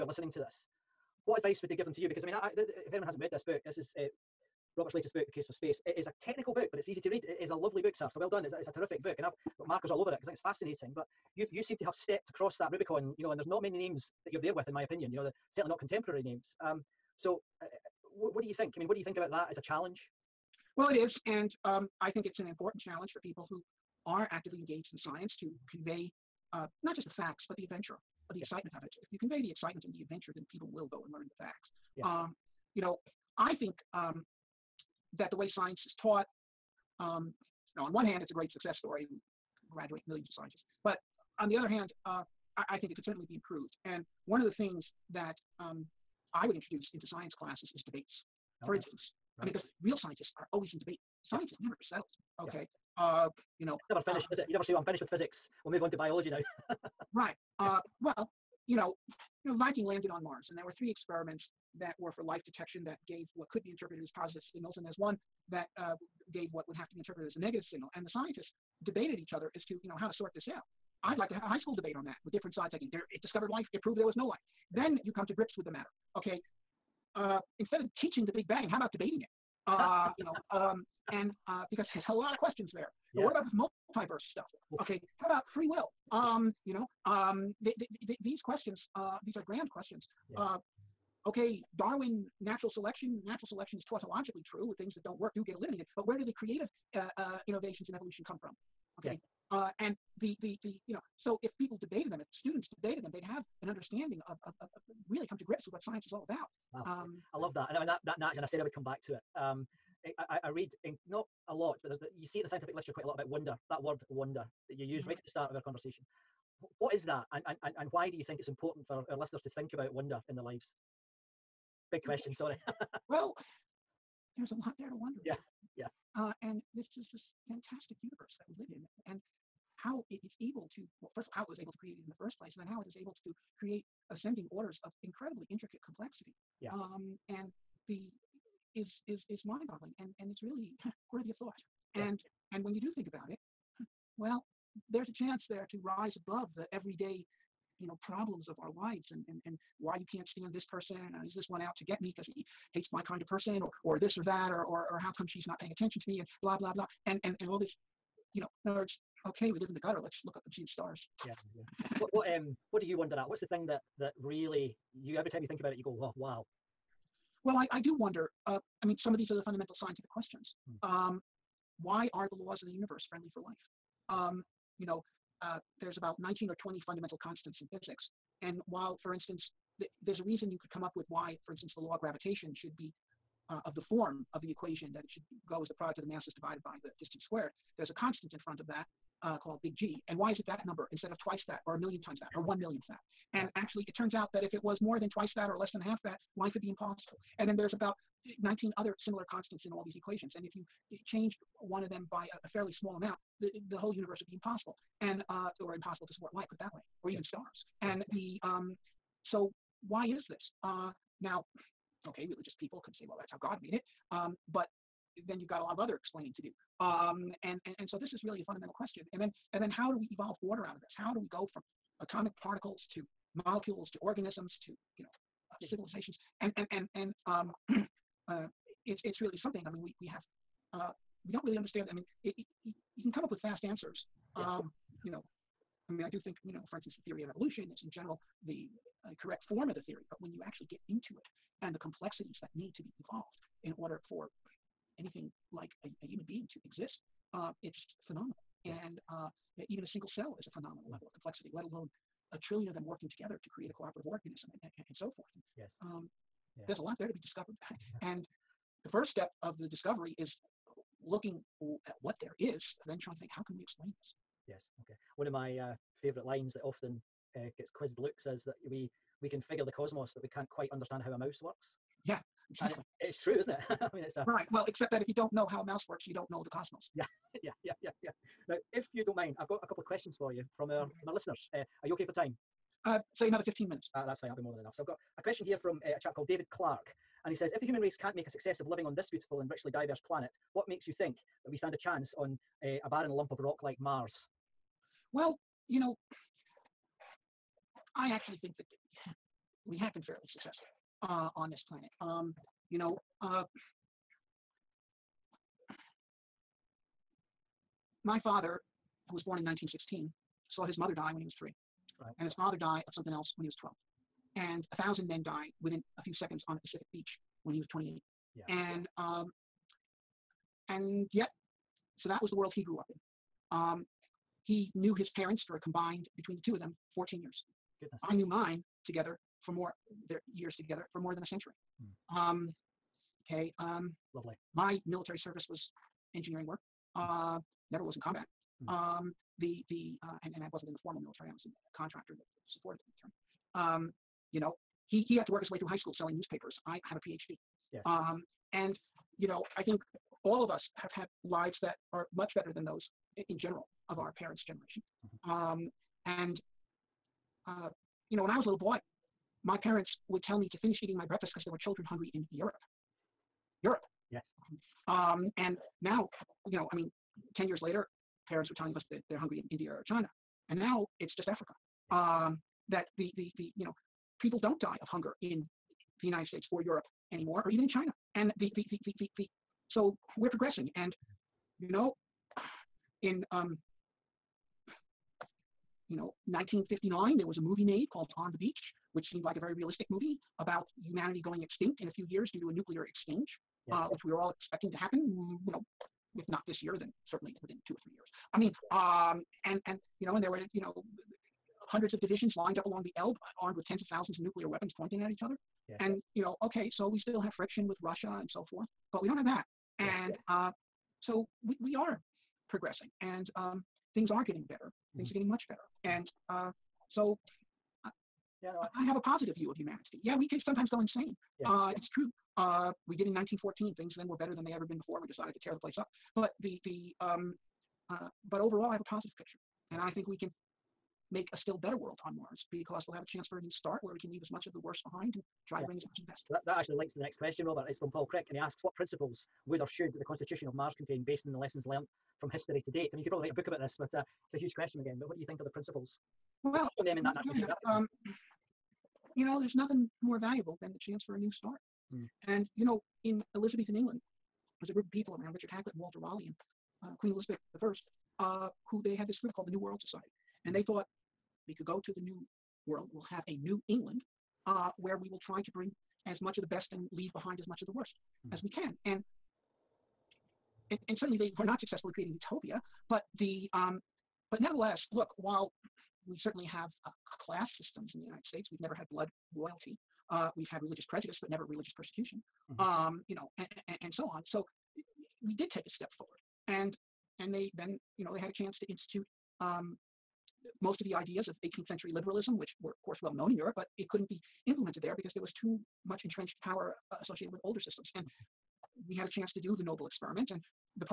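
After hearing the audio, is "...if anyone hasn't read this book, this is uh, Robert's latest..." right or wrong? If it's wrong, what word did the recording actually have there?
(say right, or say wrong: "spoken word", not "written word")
right.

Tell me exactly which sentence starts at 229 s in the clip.
I mean, we, we have, uh, we don't really understand.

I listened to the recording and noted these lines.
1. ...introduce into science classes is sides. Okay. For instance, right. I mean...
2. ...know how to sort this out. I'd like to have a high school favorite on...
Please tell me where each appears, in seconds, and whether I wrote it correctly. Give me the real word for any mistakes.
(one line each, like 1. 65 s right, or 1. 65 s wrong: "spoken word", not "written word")
1. 46 s wrong: "debates", not "sides"
2. 69 s wrong: "debate", not "favorite".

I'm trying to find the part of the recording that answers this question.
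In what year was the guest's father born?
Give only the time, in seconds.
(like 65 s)
309 s.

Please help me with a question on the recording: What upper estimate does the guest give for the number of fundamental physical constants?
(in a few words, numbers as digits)
20.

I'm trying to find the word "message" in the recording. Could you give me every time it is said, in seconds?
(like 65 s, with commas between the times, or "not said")
not said.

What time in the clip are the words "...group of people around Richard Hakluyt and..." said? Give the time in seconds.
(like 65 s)
454 s.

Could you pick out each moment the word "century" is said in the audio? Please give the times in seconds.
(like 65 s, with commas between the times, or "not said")
331 s, 491 s.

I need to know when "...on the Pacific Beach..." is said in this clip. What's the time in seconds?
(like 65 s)
316 s.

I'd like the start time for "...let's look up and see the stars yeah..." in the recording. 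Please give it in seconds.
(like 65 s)
160 s.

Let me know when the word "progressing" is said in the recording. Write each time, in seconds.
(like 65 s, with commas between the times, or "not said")
380 s, 412 s.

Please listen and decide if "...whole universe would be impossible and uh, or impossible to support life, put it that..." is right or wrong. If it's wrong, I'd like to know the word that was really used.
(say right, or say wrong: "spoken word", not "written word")
right.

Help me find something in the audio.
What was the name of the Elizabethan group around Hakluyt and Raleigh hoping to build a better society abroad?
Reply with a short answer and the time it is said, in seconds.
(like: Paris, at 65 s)
New World Society, at 459 s.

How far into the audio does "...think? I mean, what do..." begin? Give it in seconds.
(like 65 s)
18 s.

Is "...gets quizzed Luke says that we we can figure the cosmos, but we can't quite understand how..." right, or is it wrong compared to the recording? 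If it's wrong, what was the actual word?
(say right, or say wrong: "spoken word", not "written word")
right.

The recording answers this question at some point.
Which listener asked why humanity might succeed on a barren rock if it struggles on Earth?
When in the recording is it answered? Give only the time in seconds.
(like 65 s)
286 s.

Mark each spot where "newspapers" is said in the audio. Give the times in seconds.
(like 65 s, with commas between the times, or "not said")
346 s.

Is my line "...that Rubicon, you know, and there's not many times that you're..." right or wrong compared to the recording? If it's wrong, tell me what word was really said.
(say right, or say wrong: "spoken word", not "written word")
wrong: "names", not "times".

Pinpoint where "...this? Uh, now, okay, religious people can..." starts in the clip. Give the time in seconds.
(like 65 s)
210 s.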